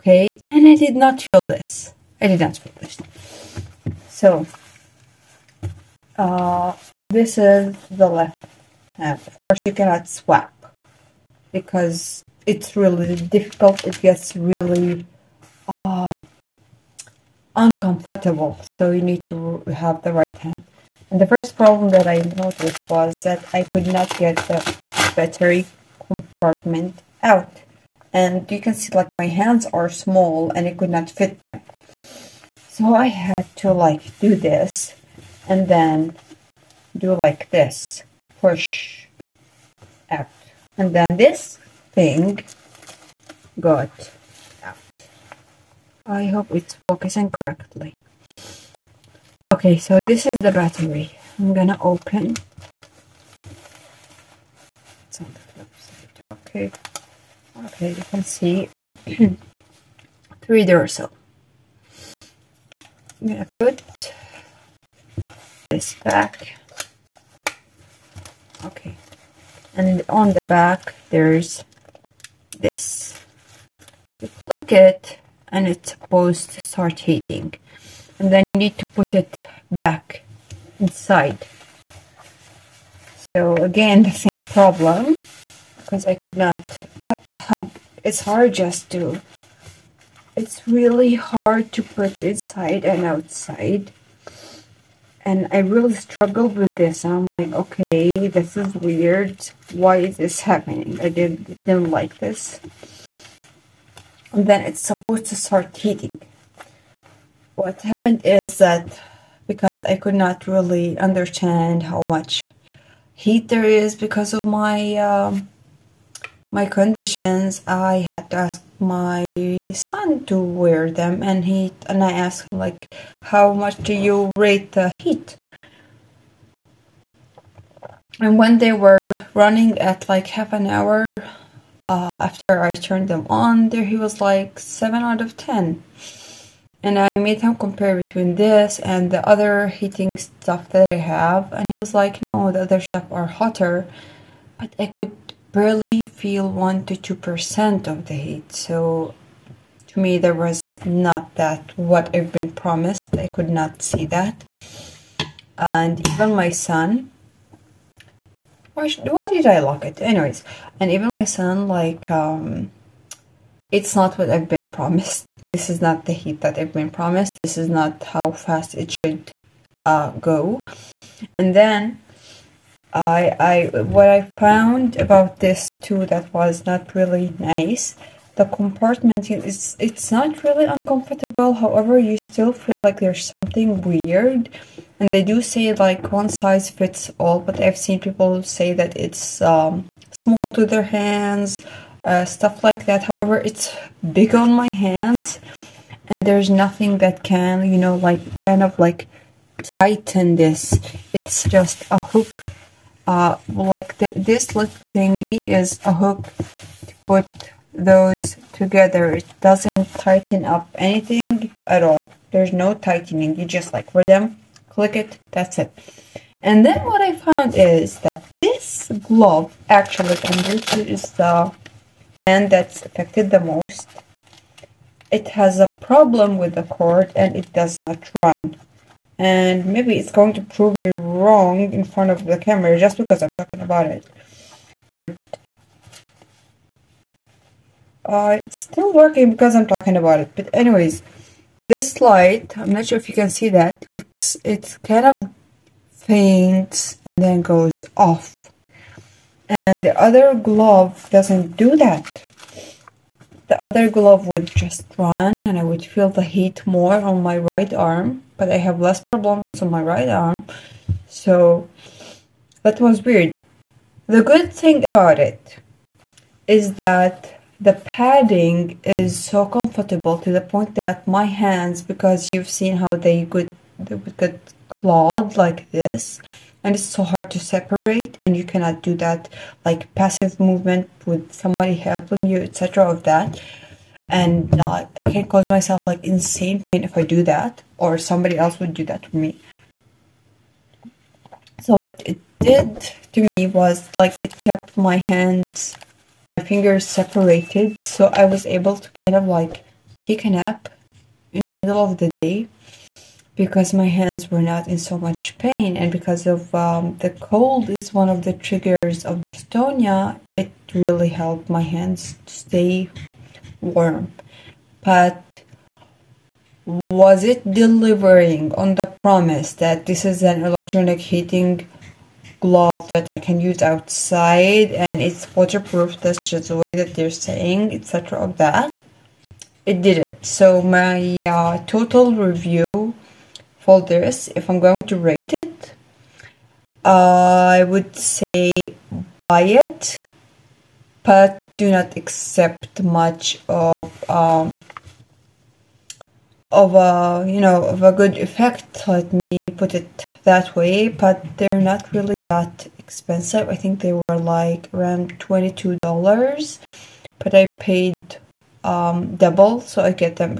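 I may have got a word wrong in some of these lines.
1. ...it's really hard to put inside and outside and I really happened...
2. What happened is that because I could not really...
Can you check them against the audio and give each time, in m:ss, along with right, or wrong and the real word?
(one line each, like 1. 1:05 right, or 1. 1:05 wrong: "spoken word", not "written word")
1. 1:30 wrong: "struggled", not "happened"
2. 1:47 right.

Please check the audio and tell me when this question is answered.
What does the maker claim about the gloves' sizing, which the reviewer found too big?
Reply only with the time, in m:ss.
3:06.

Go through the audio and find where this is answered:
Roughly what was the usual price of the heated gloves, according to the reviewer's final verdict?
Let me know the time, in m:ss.
5:55.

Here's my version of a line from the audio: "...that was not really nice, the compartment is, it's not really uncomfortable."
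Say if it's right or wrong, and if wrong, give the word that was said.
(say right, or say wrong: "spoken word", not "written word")
right.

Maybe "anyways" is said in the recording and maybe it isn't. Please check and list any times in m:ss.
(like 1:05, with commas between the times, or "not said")
2:40, 4:00.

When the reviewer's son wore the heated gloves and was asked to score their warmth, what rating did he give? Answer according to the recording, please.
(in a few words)
7 out of 10.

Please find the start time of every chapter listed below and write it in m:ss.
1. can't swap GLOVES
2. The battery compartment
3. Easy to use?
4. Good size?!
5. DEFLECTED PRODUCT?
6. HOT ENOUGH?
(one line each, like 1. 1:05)
1. 0:10
2. 0:40
3. 1:20
4. 2:50
5. 3:30
6. 5:30.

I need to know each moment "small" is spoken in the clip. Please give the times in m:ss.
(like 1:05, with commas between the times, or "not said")
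0:29, 3:10.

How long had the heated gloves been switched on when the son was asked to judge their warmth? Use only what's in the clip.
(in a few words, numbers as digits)
half an hour.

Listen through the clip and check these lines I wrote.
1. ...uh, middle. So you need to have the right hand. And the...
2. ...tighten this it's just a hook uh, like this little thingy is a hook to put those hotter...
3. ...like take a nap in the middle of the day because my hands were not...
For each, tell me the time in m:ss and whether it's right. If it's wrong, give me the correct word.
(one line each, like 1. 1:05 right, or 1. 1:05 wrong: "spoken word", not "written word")
1. 0:15 wrong: "uncomfortable", not "middle"
2. 3:19 wrong: "together", not "hotter"
3. 4:59 right.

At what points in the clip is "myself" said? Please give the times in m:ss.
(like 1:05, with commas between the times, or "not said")
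4:45.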